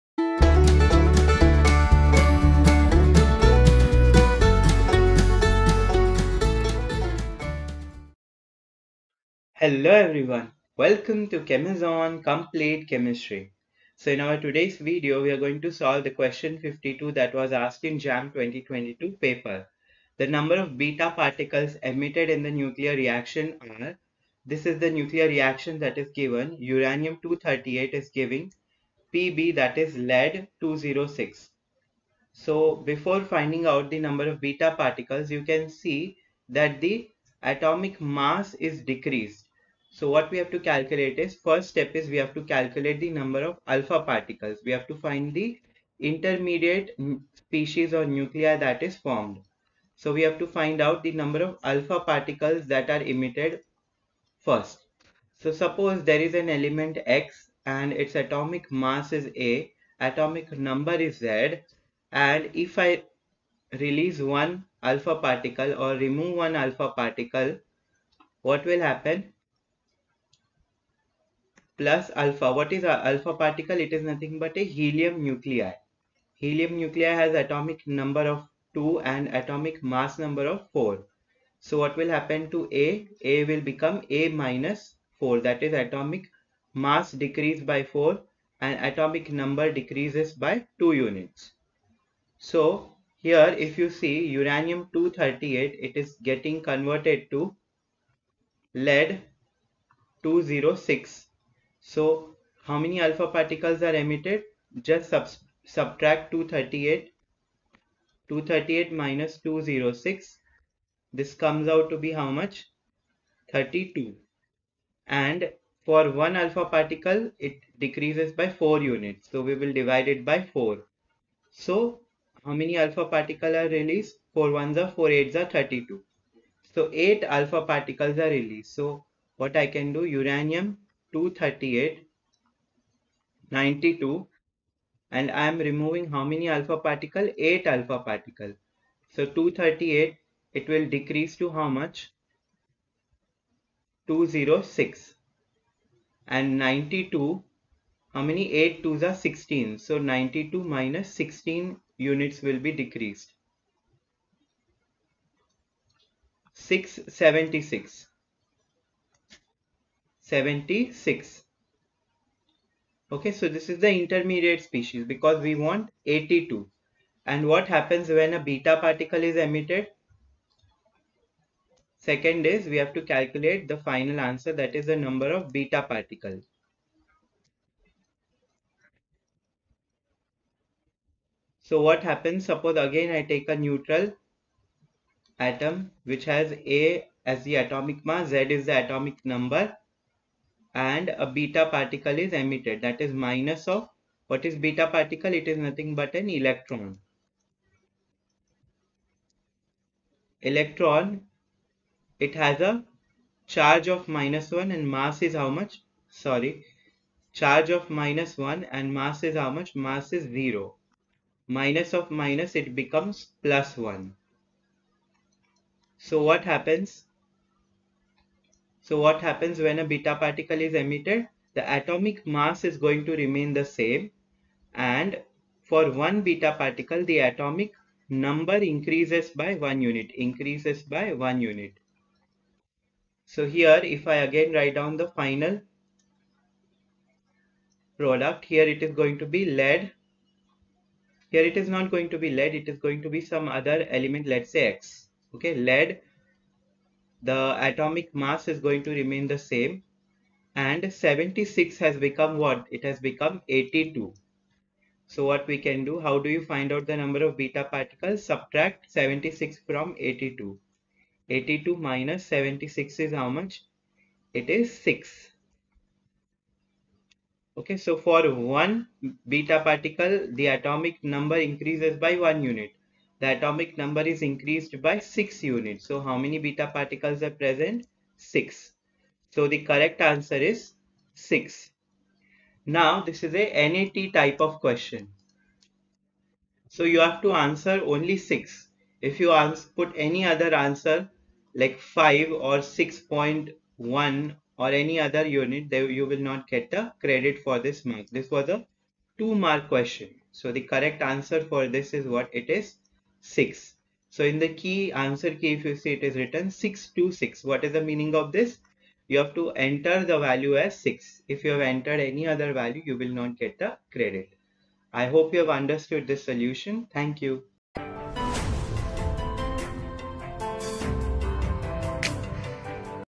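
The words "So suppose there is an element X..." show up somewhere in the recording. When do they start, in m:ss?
0:55.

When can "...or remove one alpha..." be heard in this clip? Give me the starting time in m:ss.
1:05.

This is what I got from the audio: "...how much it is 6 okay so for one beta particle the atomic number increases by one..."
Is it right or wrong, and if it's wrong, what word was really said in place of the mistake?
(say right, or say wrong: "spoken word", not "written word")
right.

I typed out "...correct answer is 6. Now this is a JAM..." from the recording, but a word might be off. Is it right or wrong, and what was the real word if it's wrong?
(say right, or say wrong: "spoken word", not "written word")
wrong: "NAT", not "JAM".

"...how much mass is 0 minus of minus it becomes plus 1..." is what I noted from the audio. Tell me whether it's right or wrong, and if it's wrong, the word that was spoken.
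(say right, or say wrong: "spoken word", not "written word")
right.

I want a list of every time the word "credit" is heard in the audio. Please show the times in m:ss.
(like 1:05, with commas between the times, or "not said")
4:56, 5:13.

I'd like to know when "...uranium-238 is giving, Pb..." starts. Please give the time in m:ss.
0:26.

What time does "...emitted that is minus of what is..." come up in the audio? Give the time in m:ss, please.
3:12.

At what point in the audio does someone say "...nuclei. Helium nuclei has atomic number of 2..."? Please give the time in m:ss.
1:15.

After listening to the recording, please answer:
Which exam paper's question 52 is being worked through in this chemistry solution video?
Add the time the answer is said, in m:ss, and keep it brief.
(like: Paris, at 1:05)
JAM 2022, at 0:17.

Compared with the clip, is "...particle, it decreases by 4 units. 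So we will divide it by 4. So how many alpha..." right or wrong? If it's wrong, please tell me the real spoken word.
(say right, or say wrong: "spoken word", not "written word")
right.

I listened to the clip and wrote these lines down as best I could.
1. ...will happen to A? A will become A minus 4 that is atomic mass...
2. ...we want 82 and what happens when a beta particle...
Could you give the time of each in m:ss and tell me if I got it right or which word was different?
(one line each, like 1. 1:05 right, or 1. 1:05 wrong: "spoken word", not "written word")
1. 1:21 right
2. 2:45 right.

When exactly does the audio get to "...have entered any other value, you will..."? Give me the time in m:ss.
5:11.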